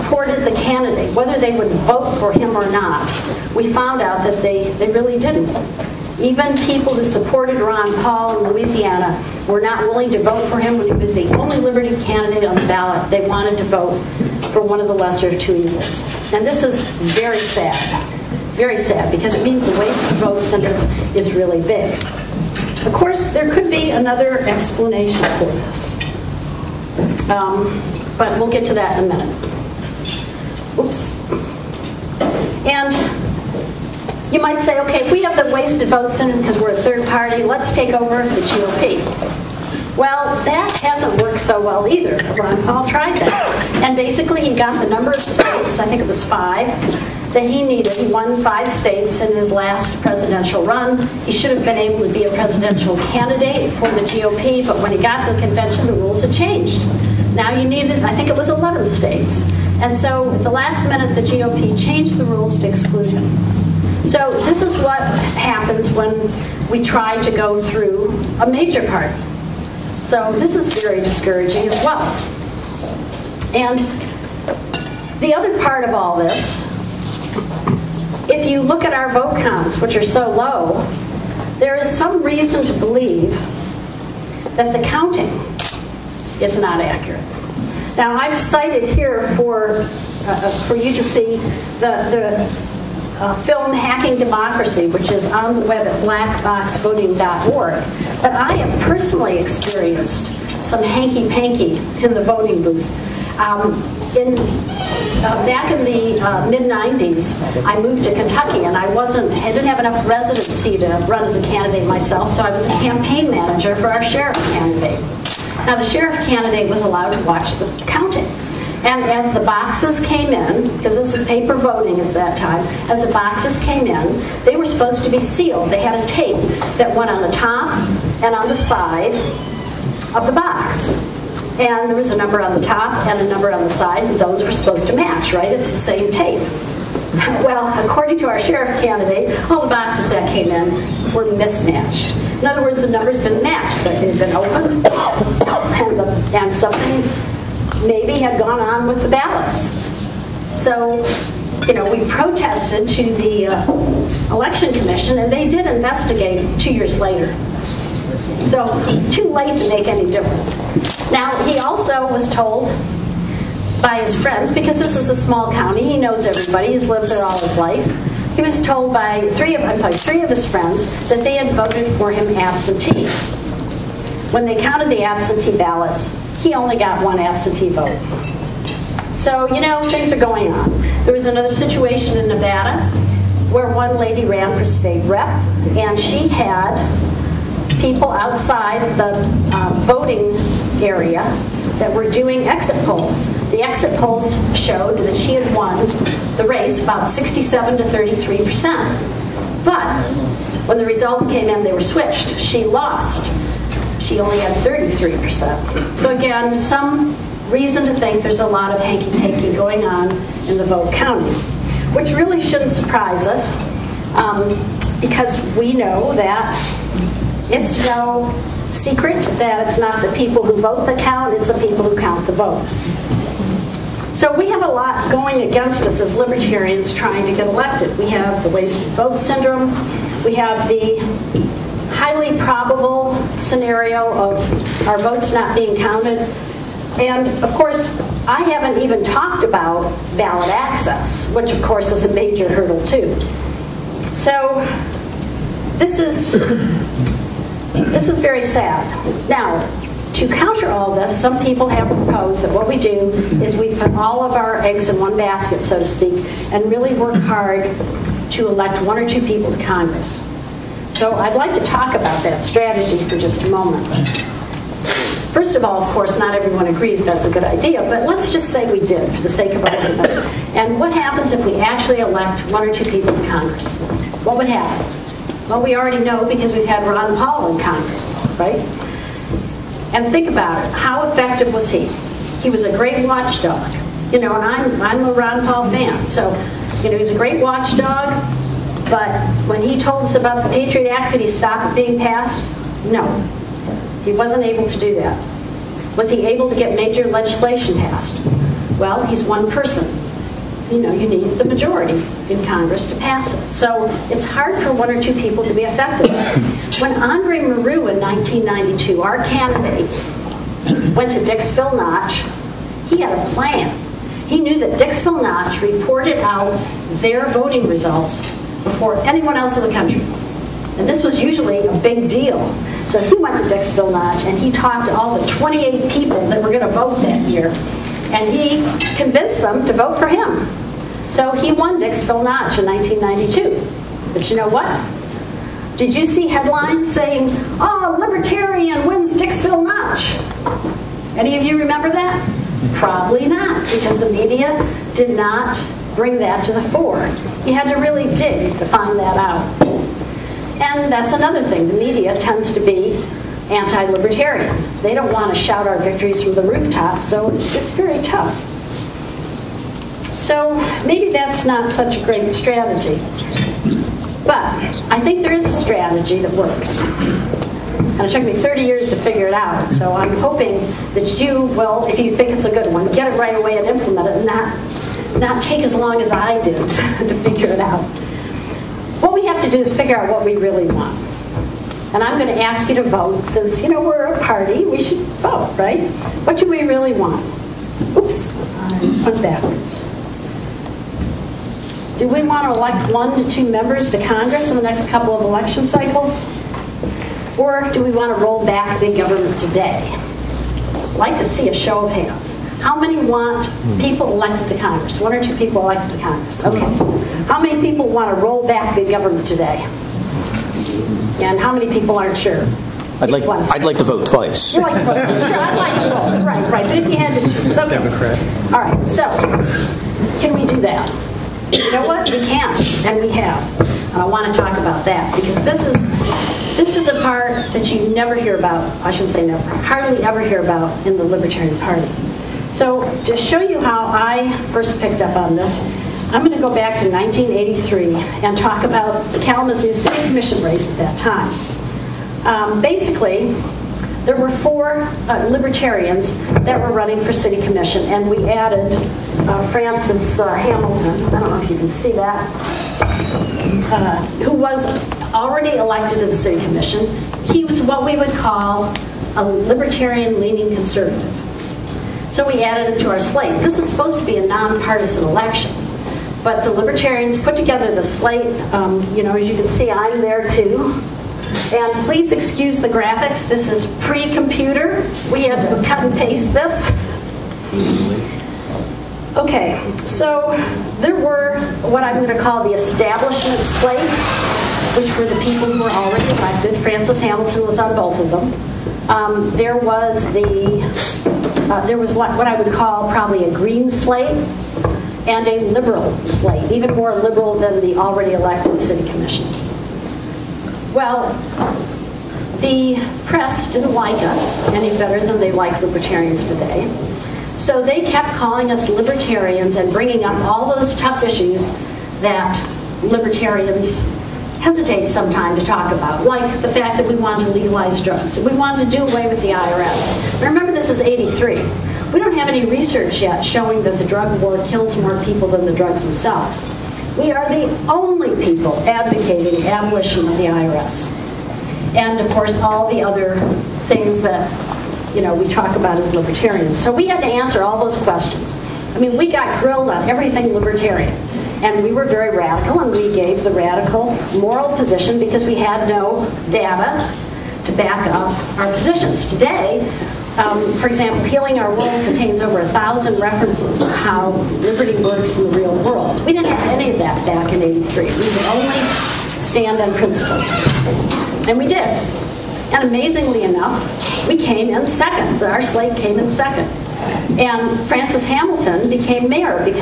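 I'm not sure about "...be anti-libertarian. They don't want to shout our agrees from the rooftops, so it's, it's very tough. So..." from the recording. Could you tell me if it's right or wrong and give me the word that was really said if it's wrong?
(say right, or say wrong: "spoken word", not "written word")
wrong: "victories", not "agrees".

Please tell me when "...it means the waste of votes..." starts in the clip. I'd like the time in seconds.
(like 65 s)
19 s.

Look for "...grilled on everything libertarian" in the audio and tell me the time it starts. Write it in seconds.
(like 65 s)
539 s.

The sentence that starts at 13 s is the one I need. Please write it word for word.
They wanted to vote for one of the lesser of two evils.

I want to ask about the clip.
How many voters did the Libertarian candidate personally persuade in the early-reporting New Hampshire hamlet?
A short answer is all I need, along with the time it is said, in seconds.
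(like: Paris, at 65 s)
28, at 325 s.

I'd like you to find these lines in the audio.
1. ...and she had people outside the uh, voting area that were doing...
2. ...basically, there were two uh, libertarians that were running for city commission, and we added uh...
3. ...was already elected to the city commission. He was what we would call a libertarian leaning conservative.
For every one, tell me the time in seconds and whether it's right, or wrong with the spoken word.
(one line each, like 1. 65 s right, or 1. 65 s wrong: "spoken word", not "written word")
1. 185 s right
2. 442 s wrong: "four", not "two"
3. 454 s right.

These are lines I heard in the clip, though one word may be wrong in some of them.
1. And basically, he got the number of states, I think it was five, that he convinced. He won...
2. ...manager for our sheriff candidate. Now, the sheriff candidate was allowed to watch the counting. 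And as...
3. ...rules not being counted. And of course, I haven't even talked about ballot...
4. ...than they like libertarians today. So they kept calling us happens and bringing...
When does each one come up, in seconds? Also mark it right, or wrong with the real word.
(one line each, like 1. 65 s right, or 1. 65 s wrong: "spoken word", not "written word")
1. 43 s wrong: "needed", not "convinced"
2. 113 s right
3. 234 s wrong: "votes", not "rules"
4. 505 s wrong: "libertarians", not "happens".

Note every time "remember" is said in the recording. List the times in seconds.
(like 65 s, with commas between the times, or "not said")
341 s, 520 s.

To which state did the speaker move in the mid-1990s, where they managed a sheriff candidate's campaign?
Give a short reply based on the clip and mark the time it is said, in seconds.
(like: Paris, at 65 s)
Kentucky, at 108 s.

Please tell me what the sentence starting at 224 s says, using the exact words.
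So we have a lot going against us as libertarians trying to get elected.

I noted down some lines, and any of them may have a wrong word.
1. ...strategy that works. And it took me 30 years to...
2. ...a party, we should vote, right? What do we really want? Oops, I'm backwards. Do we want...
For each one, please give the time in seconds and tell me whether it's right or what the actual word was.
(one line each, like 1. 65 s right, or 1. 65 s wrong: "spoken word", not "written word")
1. 365 s right
2. 384 s right.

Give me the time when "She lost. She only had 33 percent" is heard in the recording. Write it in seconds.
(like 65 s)
202 s.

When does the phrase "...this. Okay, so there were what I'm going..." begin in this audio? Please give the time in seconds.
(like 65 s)
476 s.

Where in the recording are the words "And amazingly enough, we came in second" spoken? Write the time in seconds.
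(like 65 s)
562 s.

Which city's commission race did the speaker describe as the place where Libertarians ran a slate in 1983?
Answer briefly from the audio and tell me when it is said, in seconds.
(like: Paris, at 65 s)
Kalamazoo, at 439 s.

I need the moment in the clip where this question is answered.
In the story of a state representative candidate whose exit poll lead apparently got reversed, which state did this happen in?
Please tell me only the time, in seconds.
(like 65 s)
182 s.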